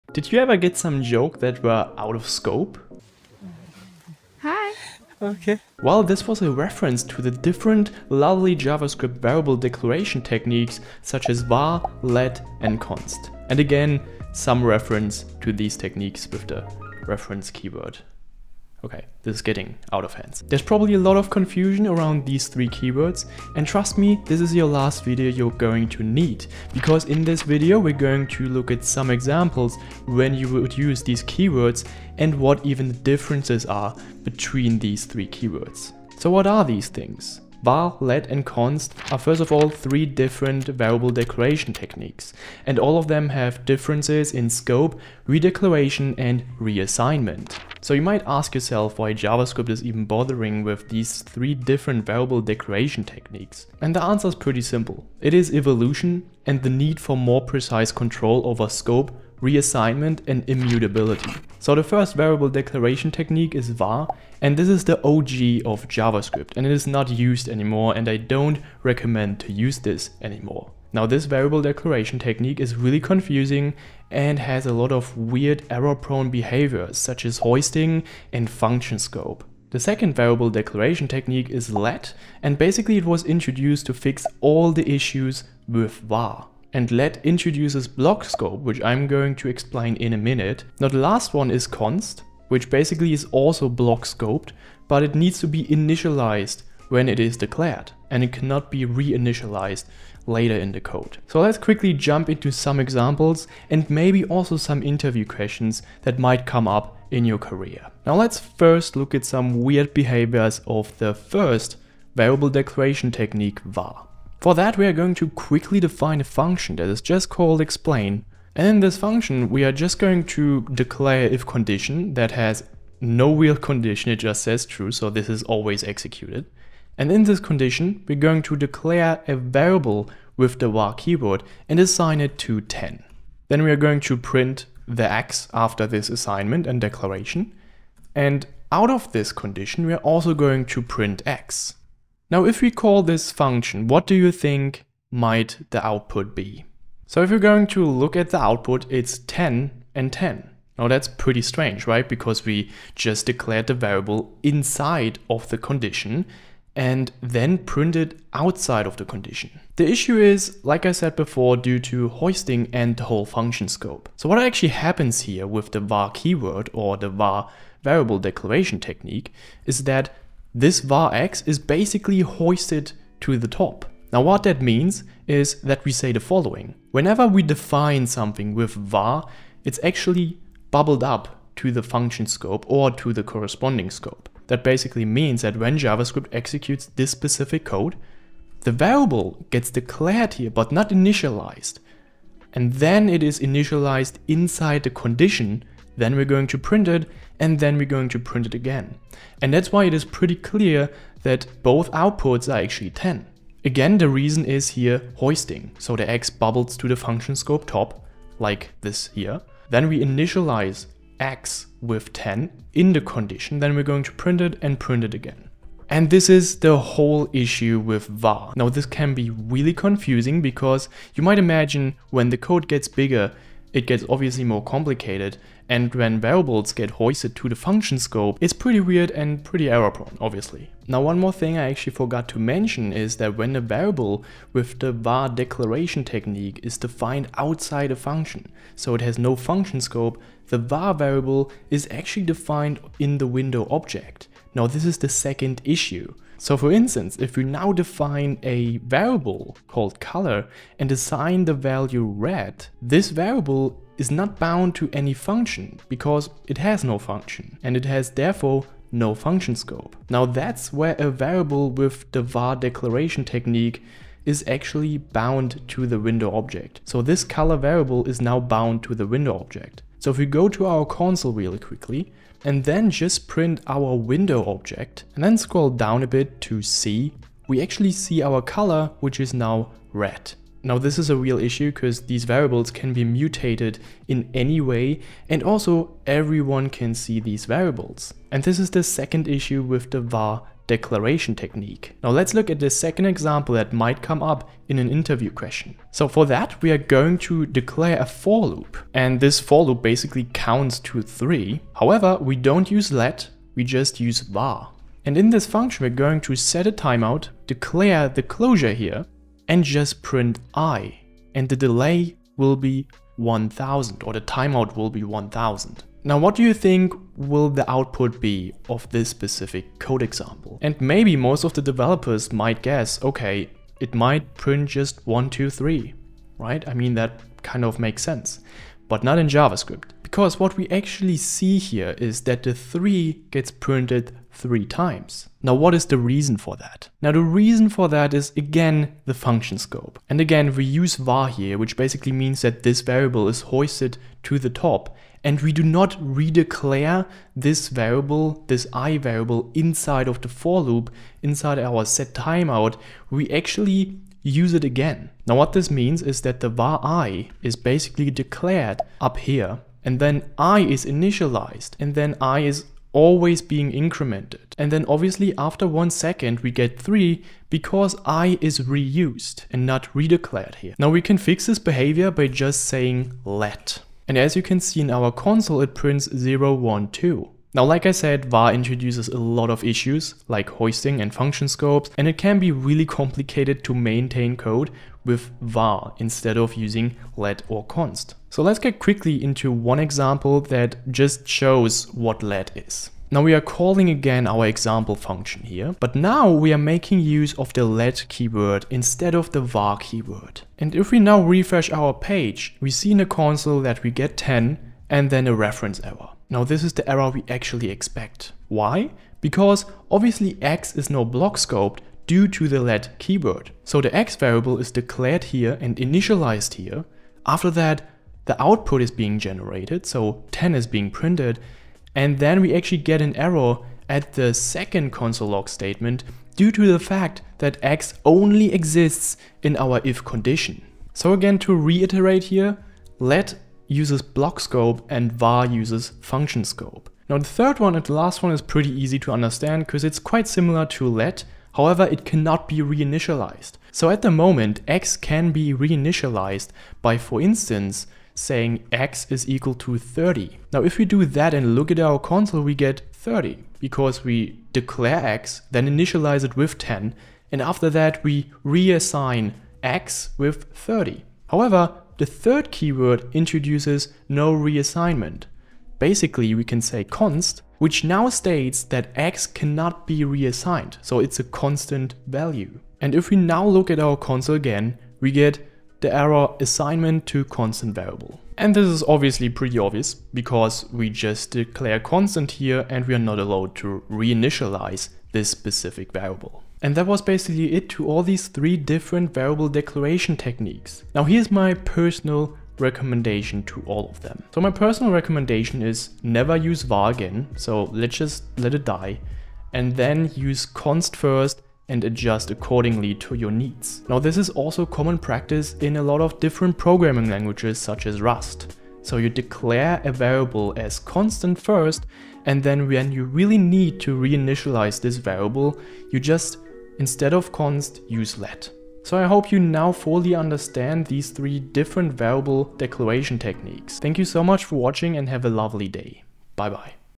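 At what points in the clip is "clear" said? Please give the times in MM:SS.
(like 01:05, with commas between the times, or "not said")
03:20.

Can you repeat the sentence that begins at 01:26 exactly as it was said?
And let introduces block scope which I'm going to explain in a minute.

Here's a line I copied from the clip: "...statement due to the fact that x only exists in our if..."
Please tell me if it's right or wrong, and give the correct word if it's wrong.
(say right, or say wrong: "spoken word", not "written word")
right.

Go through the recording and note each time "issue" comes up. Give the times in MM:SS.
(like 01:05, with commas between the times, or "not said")
01:24, 02:39, 03:37, 04:05, 04:41, 04:49, 06:19.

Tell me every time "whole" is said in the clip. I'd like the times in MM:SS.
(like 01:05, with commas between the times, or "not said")
02:43, 03:36.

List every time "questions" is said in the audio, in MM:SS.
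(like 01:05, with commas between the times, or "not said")
01:45, 04:55.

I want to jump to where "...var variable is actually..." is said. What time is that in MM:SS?
04:00.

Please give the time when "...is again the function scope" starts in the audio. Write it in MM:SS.
05:38.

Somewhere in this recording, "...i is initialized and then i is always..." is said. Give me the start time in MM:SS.
06:00.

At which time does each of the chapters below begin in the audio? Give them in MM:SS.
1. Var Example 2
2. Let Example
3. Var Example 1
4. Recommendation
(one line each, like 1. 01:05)
1. 04:51
2. 06:33
3. 01:47
4. 08:06.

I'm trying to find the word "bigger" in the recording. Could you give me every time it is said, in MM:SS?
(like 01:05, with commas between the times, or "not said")
03:42.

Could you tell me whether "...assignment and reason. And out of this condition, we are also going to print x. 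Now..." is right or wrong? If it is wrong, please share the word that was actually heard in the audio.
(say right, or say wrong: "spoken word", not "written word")
wrong: "declaration", not "reason".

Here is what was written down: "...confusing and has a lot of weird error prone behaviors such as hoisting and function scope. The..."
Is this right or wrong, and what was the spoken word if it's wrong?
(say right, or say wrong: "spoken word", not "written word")
right.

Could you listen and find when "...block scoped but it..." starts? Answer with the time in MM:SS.
01:33.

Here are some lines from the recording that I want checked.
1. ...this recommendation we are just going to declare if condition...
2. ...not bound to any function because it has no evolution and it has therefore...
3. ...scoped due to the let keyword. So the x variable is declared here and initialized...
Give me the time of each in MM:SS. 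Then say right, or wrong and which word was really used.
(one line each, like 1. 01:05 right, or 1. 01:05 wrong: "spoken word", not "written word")
1. 01:58 wrong: "function", not "recommendation"
2. 04:14 wrong: "function", not "evolution"
3. 06:51 right.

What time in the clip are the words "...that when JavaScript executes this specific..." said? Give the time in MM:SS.
03:05.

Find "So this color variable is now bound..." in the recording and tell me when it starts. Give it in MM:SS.
04:26.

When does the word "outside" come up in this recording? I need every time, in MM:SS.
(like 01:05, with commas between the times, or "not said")
02:38, 03:57.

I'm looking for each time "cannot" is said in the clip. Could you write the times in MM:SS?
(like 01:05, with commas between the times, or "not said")
01:38, 07:22, 07:49.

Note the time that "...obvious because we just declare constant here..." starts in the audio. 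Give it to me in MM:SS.
07:59.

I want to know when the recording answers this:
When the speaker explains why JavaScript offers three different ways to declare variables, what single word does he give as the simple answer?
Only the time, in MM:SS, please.
00:55.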